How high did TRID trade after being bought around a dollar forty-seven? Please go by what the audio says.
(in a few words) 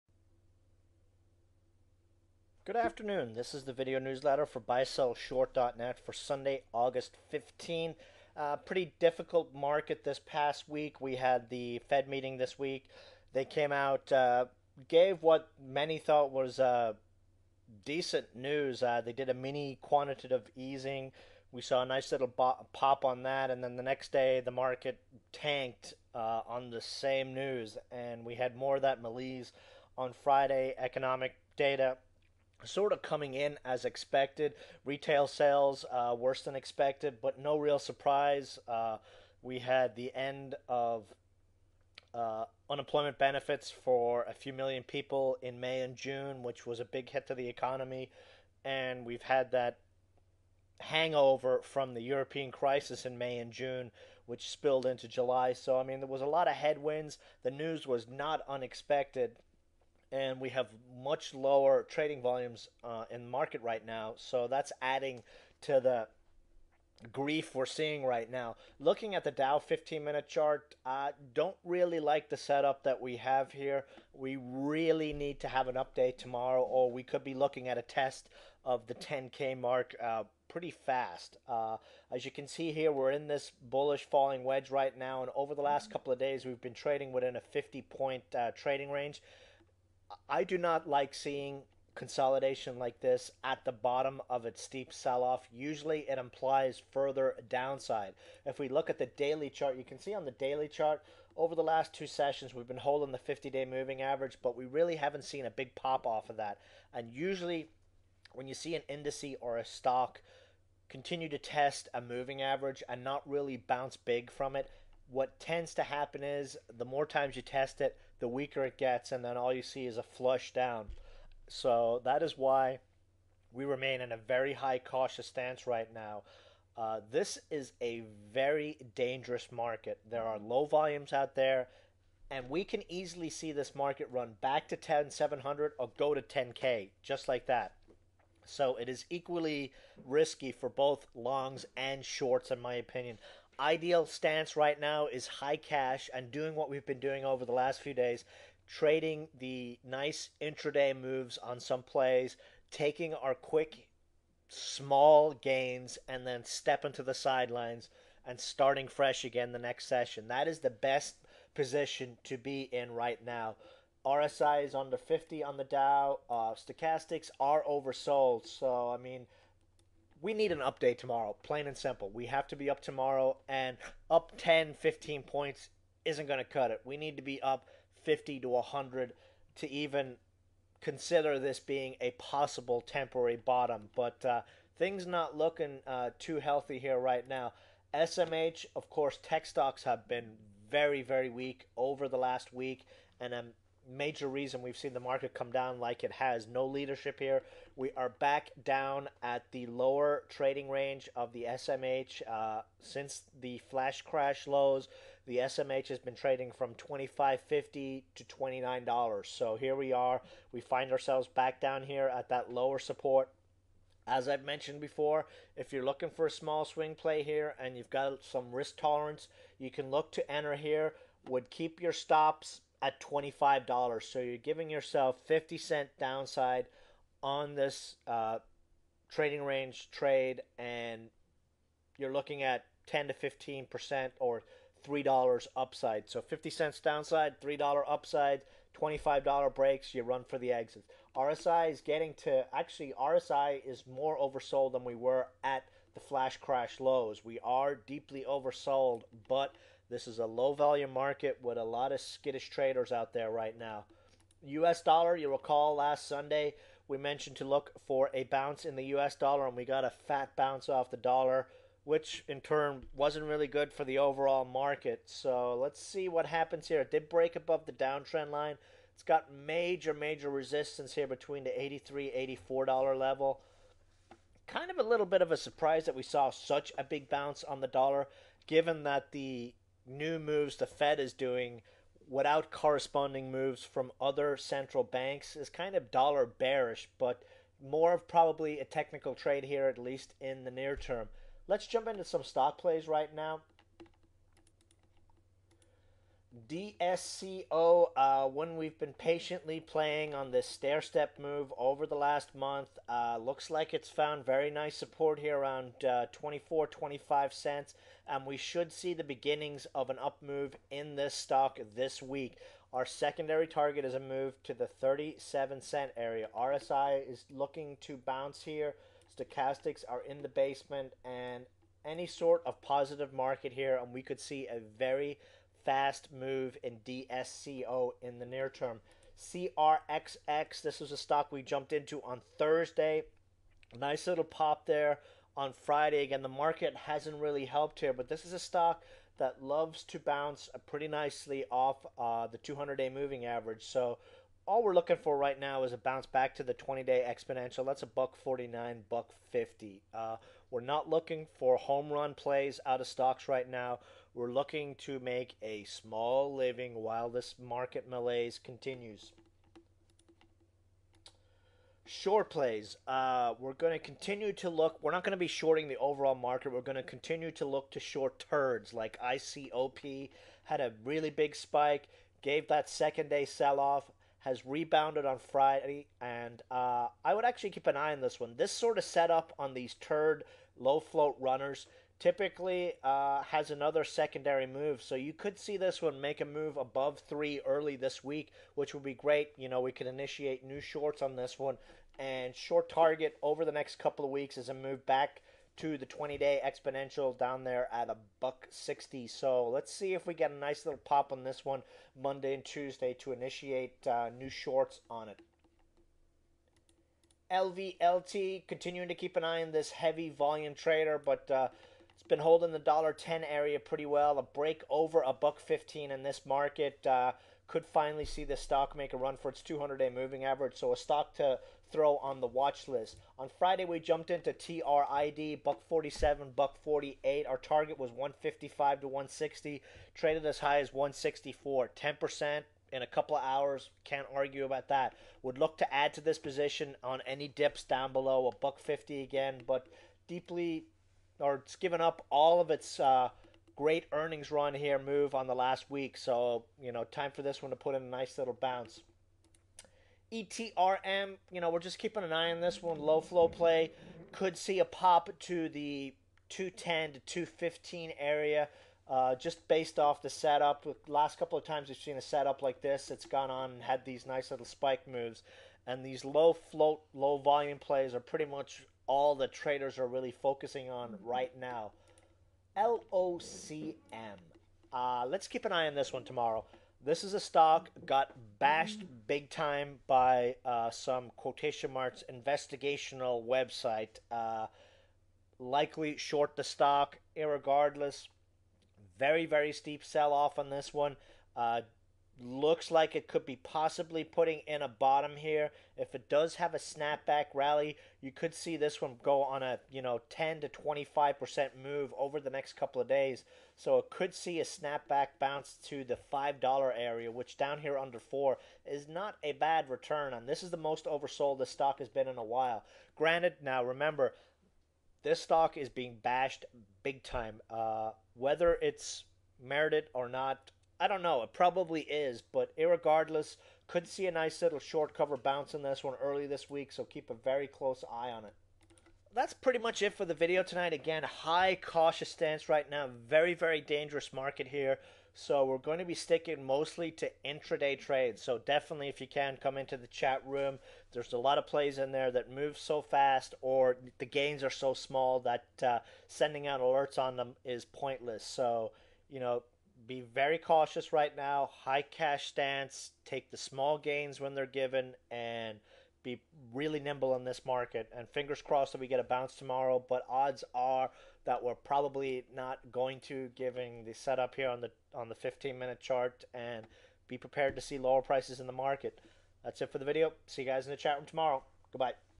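1.64.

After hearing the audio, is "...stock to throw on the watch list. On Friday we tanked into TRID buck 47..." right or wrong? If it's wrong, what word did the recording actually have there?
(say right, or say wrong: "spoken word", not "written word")
wrong: "jumped", not "tanked".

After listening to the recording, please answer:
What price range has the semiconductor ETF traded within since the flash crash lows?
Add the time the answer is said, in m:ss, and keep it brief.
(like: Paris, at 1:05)
$25.50 to $29, at 3:26.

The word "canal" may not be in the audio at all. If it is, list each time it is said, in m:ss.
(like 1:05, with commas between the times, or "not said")
not said.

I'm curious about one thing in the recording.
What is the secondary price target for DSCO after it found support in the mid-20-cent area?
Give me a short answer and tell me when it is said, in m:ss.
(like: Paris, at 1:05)
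37 cents, at 5:14.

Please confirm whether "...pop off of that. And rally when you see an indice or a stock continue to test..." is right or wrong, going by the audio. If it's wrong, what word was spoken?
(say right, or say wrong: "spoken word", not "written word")
wrong: "usually", not "rally".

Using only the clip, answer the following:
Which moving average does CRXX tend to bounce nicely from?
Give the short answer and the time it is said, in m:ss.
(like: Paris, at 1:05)
200 day moving average, at 5:42.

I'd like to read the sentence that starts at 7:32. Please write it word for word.
Low flow play could see a pop to the 210 to 215 area.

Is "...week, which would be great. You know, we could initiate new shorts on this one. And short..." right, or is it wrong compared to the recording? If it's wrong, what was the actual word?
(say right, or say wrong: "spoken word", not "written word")
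right.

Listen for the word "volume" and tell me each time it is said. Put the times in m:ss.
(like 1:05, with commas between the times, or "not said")
1:02, 2:10, 4:10, 6:50, 7:47.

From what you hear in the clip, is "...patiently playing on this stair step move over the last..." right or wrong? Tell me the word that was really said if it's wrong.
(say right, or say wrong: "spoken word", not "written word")
right.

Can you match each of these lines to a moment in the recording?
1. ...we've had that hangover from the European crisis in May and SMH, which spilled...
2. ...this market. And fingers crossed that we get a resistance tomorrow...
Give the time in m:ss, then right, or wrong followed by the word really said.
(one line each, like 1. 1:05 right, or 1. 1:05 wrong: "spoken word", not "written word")
1. 0:49 wrong: "June", not "SMH"
2. 9:17 wrong: "bounce", not "resistance".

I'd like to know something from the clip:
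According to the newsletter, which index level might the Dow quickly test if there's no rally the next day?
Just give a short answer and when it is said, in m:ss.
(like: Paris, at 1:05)
10K, at 1:18.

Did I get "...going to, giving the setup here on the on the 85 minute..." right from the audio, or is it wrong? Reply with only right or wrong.
wrong.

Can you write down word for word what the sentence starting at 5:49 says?
Uh, we're not looking for home run plays out of stocks right now.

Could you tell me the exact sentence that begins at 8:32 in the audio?
Granted, now remember, this stock is being bashed big time.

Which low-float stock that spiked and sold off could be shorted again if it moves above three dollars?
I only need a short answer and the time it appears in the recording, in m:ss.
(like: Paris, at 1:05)
ICOP, at 6:09.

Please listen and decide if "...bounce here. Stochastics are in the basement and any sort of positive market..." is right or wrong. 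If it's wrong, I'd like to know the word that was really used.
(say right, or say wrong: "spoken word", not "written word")
right.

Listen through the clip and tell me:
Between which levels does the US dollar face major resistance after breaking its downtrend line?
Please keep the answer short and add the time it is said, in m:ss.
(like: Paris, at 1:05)
83 to 84, at 4:31.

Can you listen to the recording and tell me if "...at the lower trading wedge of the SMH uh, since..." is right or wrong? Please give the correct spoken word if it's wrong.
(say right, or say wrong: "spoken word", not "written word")
wrong: "range", not "wedge".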